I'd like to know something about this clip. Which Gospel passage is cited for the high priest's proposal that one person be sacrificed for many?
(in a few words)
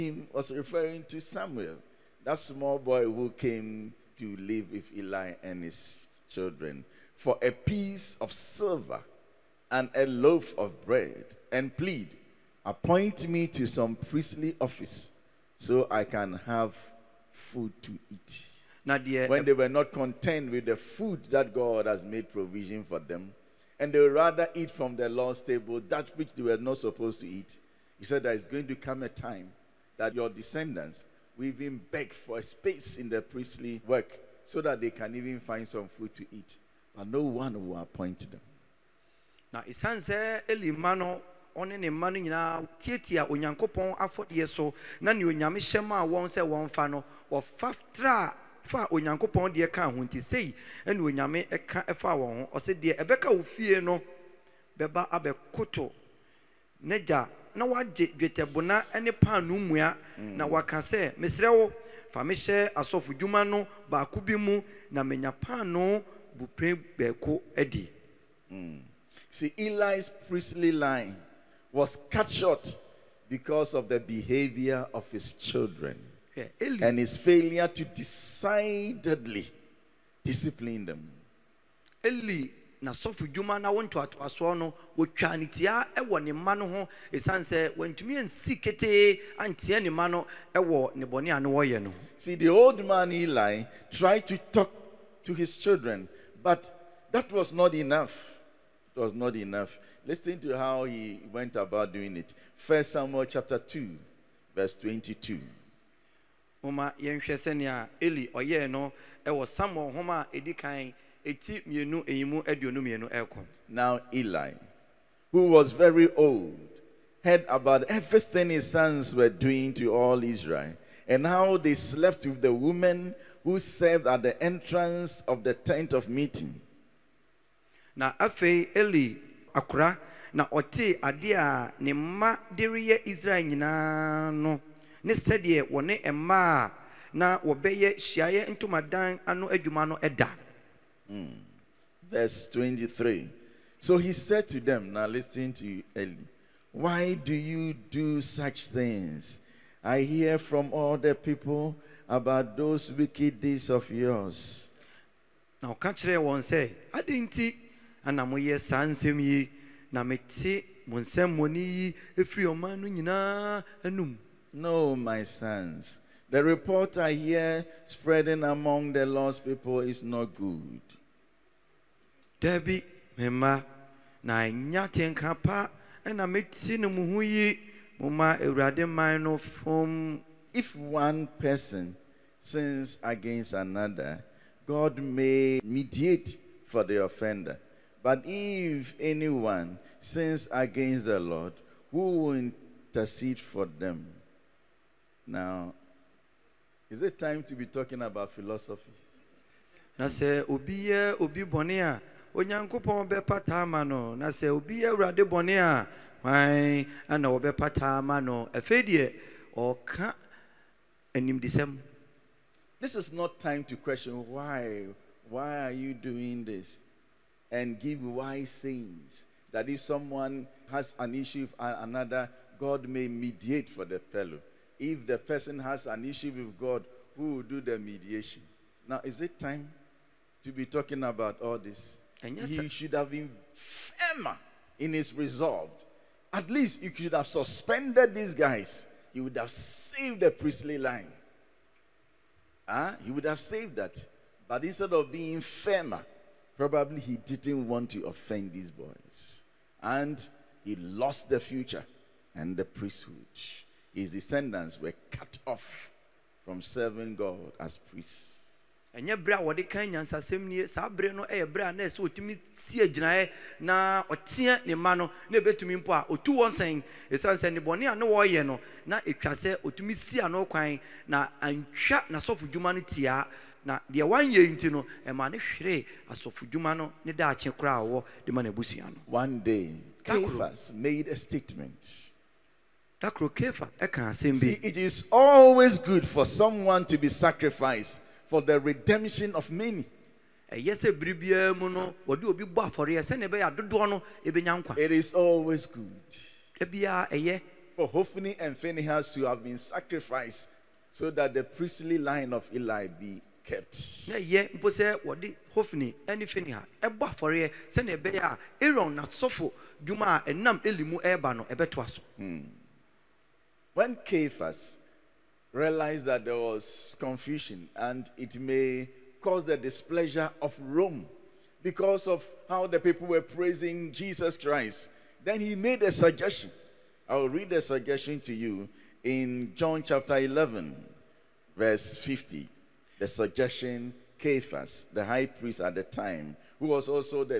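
John 11:50.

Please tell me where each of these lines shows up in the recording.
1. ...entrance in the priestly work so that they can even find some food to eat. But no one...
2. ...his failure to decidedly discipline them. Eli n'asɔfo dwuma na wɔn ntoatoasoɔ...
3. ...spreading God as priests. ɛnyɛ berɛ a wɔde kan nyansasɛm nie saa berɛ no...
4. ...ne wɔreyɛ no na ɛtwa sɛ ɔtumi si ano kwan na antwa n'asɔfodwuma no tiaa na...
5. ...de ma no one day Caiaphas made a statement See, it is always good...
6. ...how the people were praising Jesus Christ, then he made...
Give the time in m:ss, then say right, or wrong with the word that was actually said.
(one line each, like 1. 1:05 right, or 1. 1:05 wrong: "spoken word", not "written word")
1. 0:32 wrong: "space", not "entrance"
2. 1:16 right
3. 4:16 wrong: "serving", not "spreading"
4. 4:27 right
5. 4:38 right
6. 5:22 right.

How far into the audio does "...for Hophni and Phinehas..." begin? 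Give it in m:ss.
4:57.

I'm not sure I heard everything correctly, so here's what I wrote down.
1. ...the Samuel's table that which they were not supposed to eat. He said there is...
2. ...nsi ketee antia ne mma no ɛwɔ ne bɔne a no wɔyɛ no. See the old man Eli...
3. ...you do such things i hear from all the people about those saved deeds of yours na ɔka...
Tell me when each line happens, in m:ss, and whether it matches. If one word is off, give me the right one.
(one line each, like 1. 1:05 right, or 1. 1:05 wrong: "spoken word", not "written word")
1. 0:24 wrong: "Lord", not "Samuel"
2. 1:28 right
3. 2:27 wrong: "wicked", not "saved".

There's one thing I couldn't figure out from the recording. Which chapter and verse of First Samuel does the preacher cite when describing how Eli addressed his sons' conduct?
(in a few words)
Chapter 2 verse 22.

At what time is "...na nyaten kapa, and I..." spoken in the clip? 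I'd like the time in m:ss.
2:54.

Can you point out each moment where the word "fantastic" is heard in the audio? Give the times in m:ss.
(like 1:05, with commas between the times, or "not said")
not said.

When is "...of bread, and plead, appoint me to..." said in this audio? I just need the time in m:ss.
0:10.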